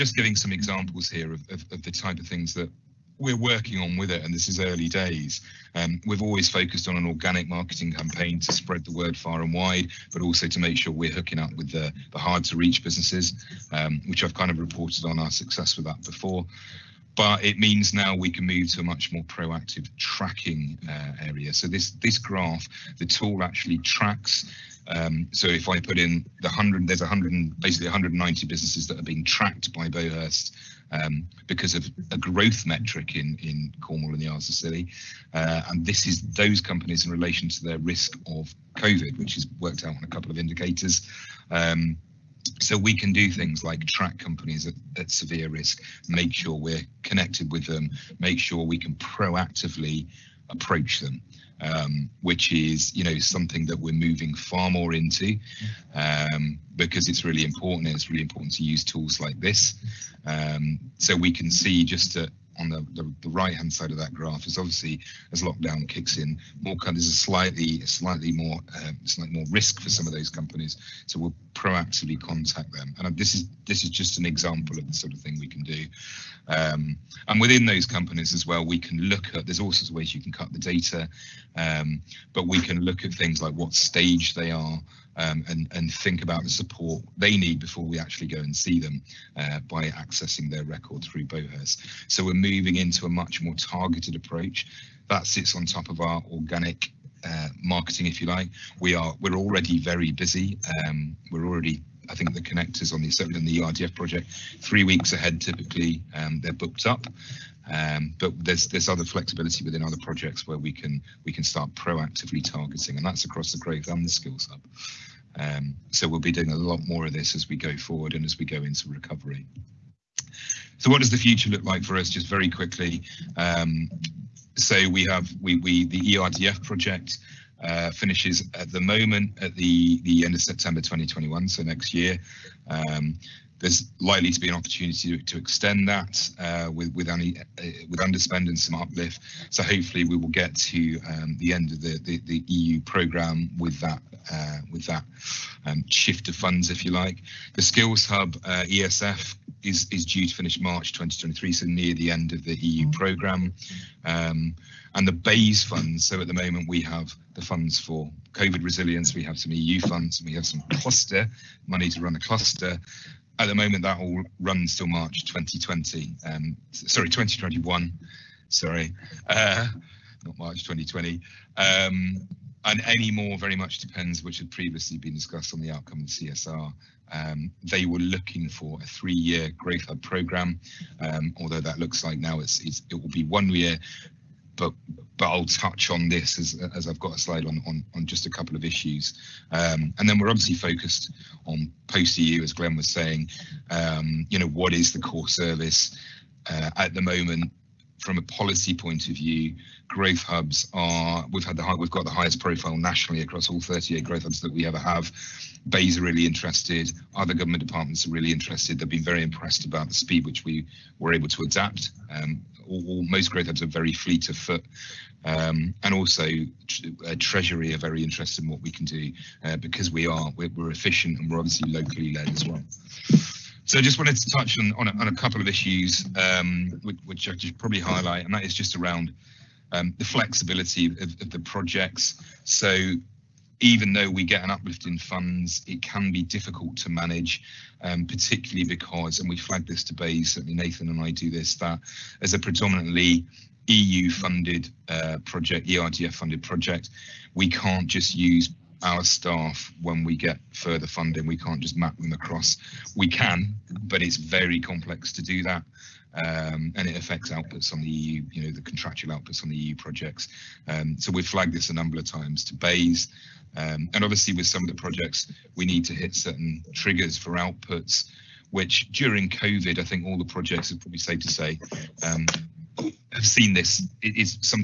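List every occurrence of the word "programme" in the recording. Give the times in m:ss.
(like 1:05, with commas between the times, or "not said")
2:22, 2:32, 3:00.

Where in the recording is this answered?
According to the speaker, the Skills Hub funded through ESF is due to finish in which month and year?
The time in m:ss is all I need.
2:30.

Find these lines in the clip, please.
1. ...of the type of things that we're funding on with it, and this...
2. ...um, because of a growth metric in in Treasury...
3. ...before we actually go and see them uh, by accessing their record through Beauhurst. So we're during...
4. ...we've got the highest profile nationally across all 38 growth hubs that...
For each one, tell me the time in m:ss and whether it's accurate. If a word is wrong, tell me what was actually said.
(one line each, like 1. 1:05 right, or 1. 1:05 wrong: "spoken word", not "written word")
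1. 0:01 wrong: "working", not "funding"
2. 0:30 wrong: "Cornwall", not "Treasury"
3. 1:27 wrong: "moving", not "during"
4. 3:21 right.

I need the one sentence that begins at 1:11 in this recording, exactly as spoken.
So we'll proactively contact them, and uh, this is this is just an example of the sort of thing we can do.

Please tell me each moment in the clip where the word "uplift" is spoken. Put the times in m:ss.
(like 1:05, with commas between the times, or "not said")
2:18, 3:54.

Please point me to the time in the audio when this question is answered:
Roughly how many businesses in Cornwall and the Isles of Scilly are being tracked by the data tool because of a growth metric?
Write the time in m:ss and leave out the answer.
0:27.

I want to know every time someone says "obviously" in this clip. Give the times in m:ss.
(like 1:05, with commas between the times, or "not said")
1:04, 3:10, 3:41, 4:24.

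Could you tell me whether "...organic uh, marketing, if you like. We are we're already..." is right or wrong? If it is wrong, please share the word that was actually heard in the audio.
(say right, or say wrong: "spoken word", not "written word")
right.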